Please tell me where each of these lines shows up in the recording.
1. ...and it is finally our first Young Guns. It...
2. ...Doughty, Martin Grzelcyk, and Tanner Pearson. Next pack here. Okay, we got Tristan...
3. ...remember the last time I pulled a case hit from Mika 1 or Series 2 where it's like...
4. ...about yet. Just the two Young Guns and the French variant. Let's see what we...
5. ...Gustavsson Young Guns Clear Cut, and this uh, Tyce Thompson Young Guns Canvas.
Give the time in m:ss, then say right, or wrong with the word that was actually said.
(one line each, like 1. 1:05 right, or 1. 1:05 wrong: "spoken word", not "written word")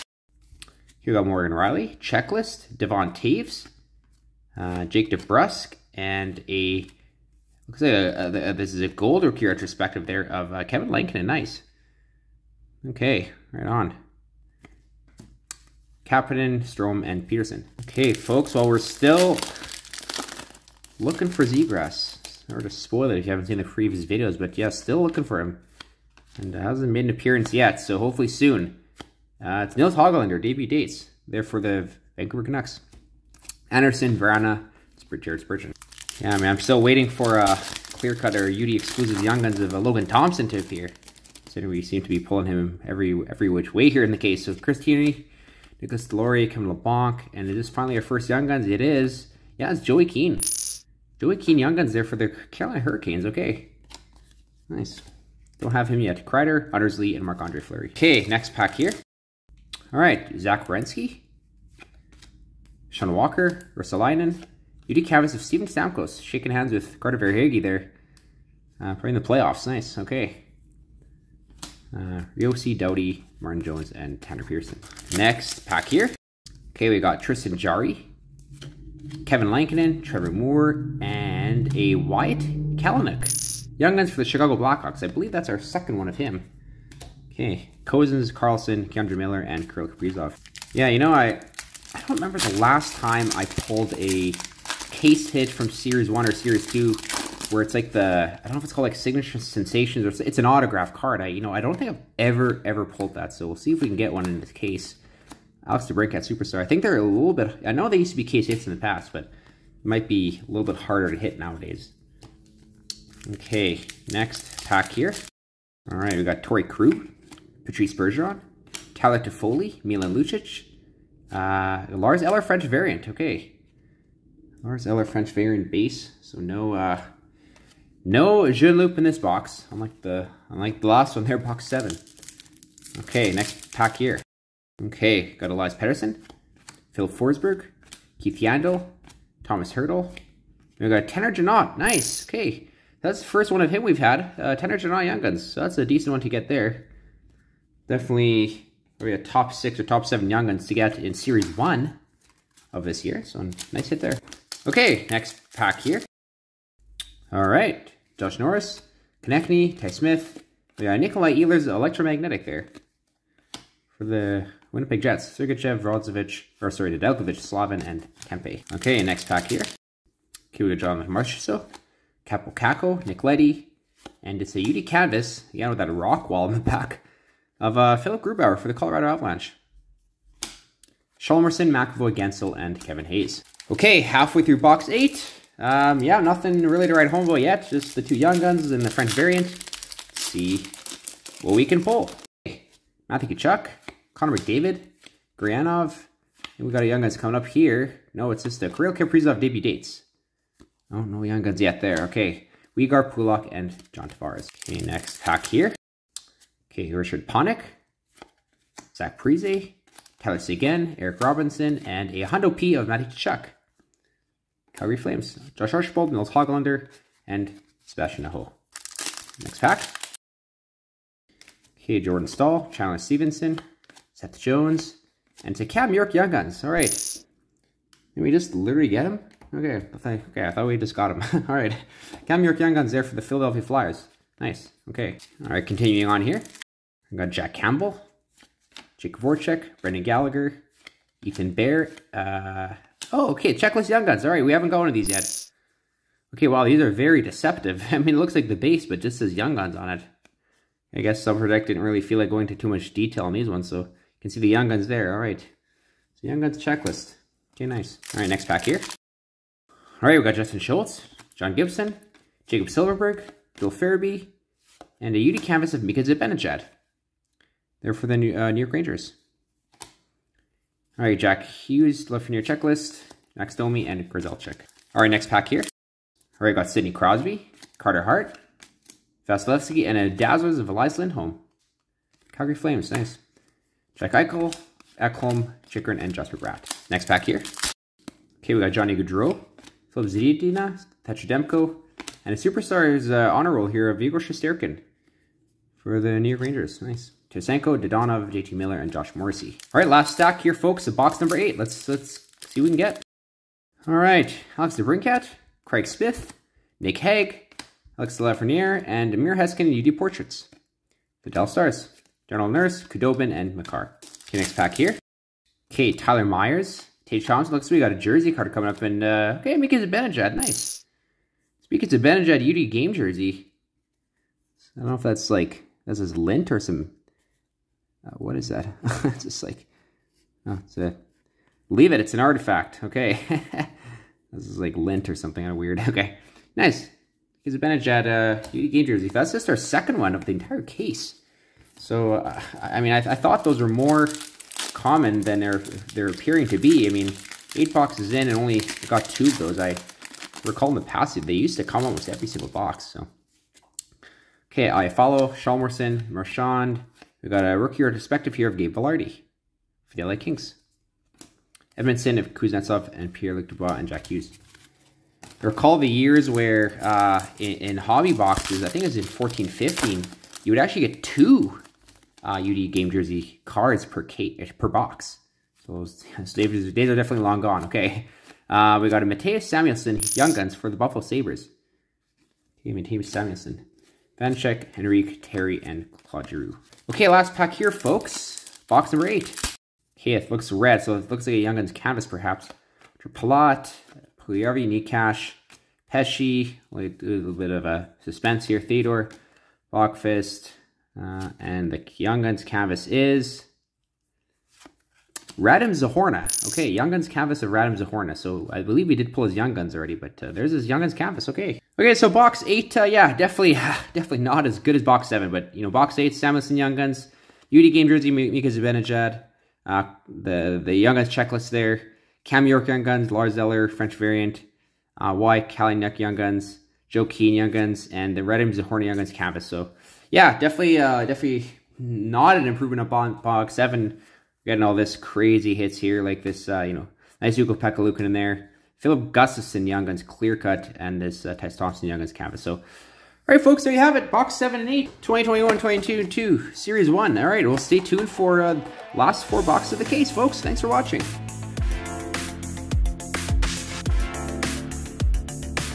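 1. 0:47 right
2. 1:12 wrong: "Jones", not "Grzelcyk"
3. 1:32 wrong: "Series", not "Mika"
4. 3:07 right
5. 7:19 right.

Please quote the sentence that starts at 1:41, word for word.
I, you know, I don't think I've ever, ever pulled that.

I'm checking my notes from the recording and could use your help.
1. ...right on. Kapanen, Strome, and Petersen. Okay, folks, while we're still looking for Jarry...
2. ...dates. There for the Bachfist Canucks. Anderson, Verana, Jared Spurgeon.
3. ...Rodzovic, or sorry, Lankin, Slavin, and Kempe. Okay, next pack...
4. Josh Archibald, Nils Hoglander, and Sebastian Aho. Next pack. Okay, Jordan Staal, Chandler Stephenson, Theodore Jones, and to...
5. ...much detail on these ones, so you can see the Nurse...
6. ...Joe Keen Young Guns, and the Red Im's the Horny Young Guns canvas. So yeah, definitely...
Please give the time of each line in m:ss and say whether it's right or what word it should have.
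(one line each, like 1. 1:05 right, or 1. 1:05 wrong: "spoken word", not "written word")
1. 0:13 wrong: "Zegras", not "Jarry"
2. 0:30 wrong: "Vancouver", not "Bachfist"
3. 2:45 wrong: "Nedeljkovic", not "Lankin"
4. 3:35 wrong: "Seth", not "Theodore"
5. 4:12 wrong: "Young", not "Nurse"
6. 7:06 right.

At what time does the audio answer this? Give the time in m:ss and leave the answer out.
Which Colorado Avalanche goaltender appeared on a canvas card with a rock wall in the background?
2:57.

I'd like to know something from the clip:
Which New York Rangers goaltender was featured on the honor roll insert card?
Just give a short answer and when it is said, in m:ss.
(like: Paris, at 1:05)
Igor Shesterkin, at 4:54.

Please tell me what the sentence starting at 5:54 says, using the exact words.
Okay, I follow Shalmerson, Marchand, We've got a rookie retrospective here of Gabe Velarde for the LA Kings.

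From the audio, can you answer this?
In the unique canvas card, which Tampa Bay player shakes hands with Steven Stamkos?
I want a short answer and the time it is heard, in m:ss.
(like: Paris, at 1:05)
Carter Verhaeghe, at 1:07.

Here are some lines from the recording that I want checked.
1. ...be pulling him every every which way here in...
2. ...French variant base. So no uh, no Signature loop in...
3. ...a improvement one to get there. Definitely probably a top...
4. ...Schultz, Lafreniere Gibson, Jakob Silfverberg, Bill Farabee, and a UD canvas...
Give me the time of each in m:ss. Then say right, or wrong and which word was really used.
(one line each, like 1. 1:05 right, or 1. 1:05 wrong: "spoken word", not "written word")
1. 0:42 right
2. 2:05 wrong: "Jean", not "Signature"
3. 2:25 wrong: "decent", not "improvement"
4. 4:20 wrong: "John", not "Lafreniere".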